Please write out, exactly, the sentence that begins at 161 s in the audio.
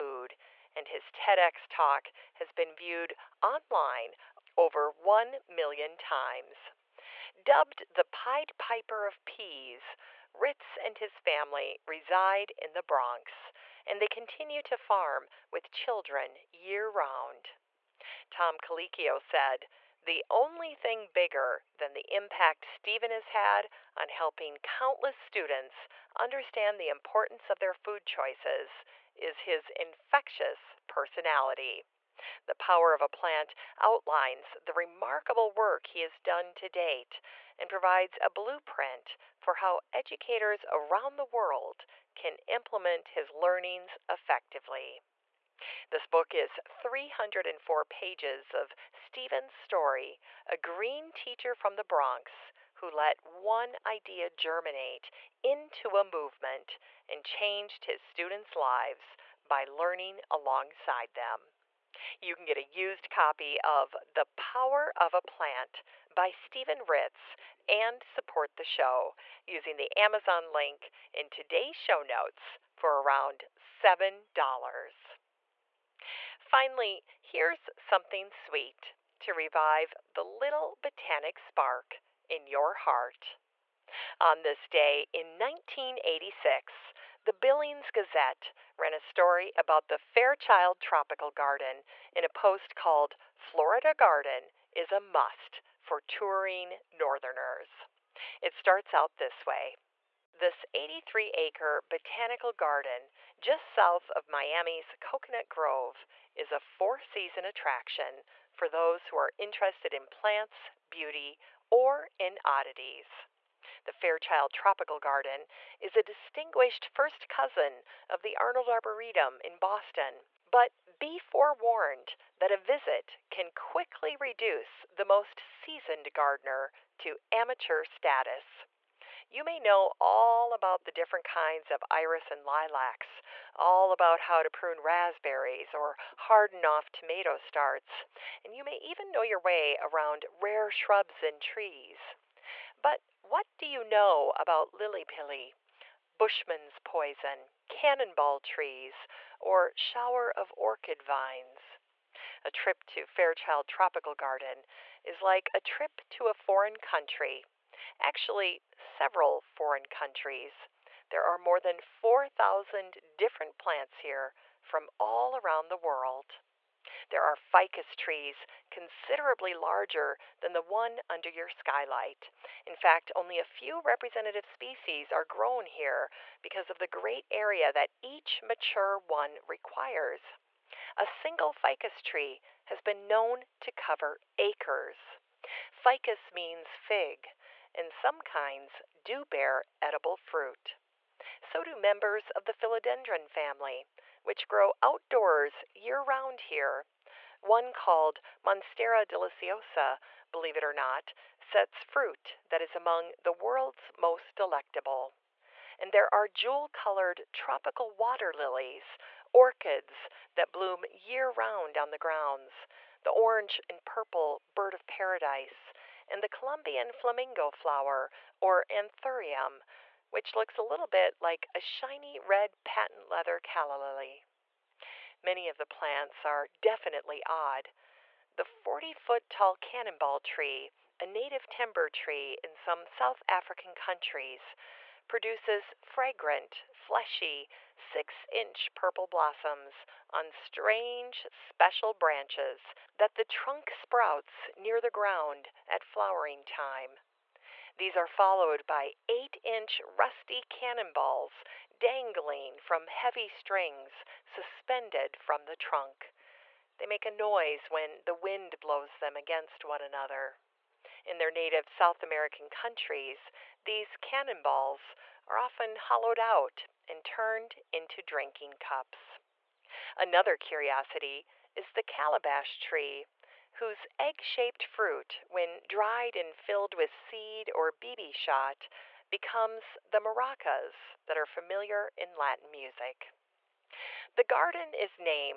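There are more than 4,000 different plants here from all around the world.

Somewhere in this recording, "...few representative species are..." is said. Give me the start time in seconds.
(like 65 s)
173 s.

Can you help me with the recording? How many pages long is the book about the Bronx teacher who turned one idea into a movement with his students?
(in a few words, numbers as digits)
304.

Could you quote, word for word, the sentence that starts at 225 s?
Many of the plants are definitely odd.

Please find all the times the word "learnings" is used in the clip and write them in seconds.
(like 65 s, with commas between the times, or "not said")
43 s, 59 s.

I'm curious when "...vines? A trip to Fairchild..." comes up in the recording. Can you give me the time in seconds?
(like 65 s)
151 s.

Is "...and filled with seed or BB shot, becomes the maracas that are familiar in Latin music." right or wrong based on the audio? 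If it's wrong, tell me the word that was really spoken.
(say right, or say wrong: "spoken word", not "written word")
right.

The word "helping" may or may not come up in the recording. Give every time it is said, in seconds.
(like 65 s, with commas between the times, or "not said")
24 s.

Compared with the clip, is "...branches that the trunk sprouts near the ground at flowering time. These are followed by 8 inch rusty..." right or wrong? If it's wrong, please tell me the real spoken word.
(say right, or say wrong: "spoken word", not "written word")
right.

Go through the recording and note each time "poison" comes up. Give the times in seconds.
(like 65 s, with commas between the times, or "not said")
146 s.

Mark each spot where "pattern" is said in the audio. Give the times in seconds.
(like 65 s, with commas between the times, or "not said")
not said.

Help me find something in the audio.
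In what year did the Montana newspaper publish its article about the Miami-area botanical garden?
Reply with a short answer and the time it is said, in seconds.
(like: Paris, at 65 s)
1986, at 85 s.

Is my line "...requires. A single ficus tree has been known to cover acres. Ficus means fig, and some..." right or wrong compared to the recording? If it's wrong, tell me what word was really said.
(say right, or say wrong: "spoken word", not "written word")
right.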